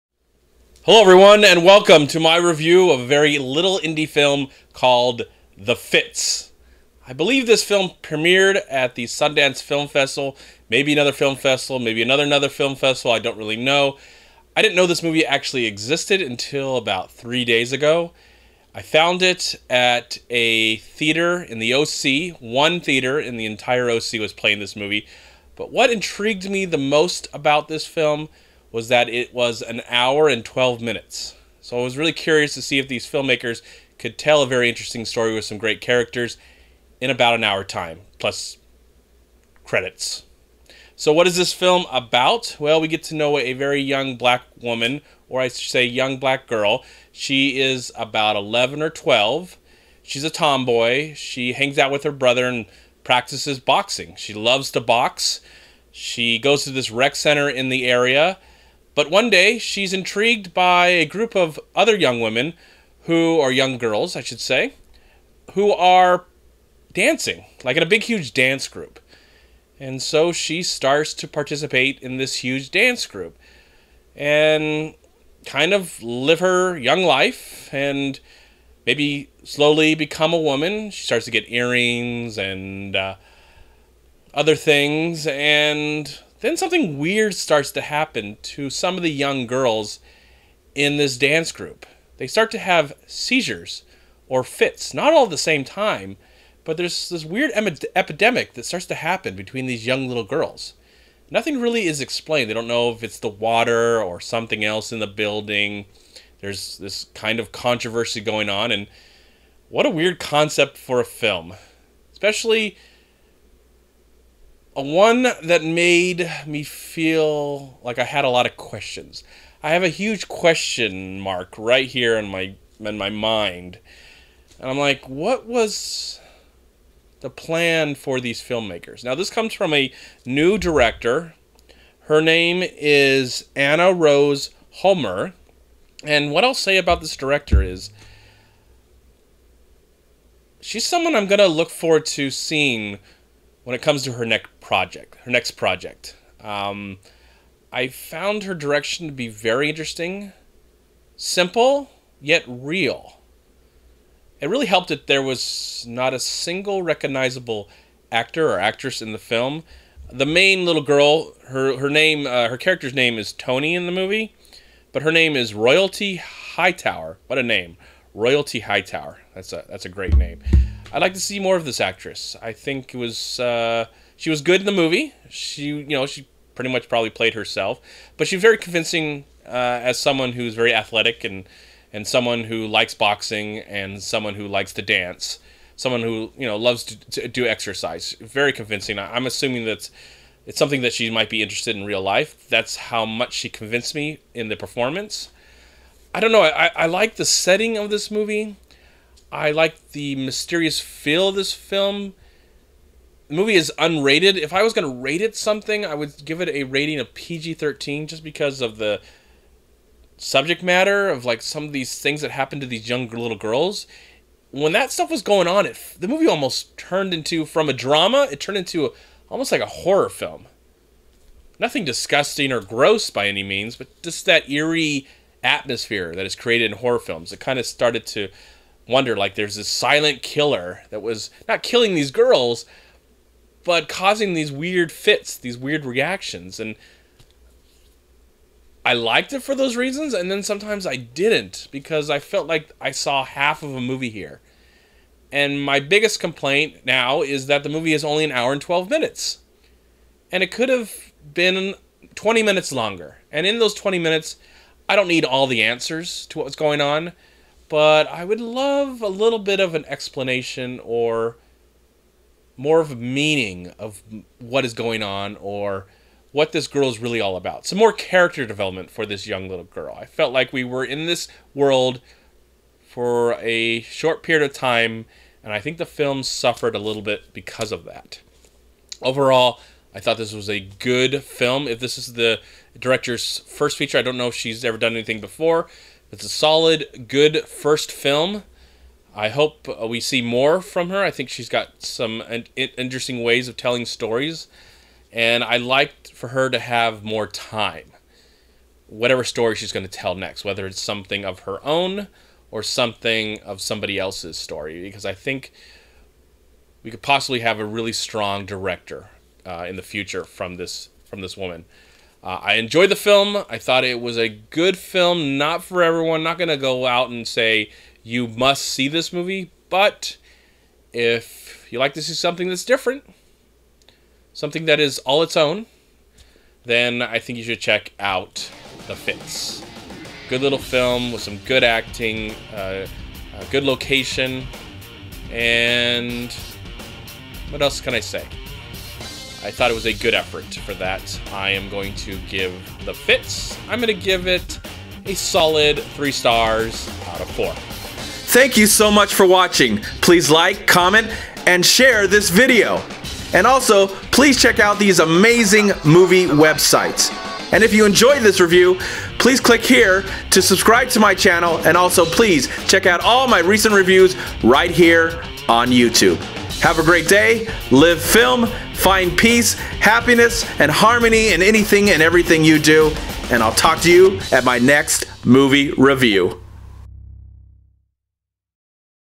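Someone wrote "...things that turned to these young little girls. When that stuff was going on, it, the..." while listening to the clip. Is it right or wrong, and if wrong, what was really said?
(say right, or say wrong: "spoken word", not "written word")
wrong: "happened", not "turned".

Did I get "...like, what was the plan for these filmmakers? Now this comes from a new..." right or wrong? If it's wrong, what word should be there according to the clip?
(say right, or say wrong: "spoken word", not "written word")
right.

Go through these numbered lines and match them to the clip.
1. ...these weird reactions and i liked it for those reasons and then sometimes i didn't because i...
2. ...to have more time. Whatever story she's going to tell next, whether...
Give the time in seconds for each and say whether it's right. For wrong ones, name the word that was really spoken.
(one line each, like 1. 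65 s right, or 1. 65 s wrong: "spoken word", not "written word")
1. 235 s right
2. 296 s right.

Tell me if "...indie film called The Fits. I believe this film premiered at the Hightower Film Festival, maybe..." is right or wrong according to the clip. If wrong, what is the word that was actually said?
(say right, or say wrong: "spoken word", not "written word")
wrong: "Sundance", not "Hightower".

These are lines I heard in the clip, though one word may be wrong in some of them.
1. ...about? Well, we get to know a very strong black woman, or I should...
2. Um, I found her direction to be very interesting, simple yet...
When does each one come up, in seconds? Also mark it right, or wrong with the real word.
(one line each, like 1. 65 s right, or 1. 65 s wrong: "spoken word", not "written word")
1. 41 s wrong: "young", not "strong"
2. 146 s right.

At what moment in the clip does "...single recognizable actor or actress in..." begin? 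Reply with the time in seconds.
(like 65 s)
156 s.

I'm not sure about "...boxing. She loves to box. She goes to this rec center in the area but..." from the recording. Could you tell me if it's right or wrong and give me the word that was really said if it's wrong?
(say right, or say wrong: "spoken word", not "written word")
right.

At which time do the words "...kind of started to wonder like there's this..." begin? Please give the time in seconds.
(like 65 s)
227 s.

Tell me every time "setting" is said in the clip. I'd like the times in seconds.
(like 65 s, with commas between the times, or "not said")
197 s.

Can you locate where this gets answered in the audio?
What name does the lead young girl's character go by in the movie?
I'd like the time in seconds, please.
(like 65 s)
163 s.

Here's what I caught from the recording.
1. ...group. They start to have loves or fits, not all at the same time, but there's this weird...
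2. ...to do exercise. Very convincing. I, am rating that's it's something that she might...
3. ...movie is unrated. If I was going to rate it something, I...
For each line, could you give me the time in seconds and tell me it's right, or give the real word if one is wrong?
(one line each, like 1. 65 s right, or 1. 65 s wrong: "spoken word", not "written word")
1. 91 s wrong: "seizures", not "loves"
2. 187 s wrong: "assuming", not "rating"
3. 203 s right.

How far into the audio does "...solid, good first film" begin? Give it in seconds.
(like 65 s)
286 s.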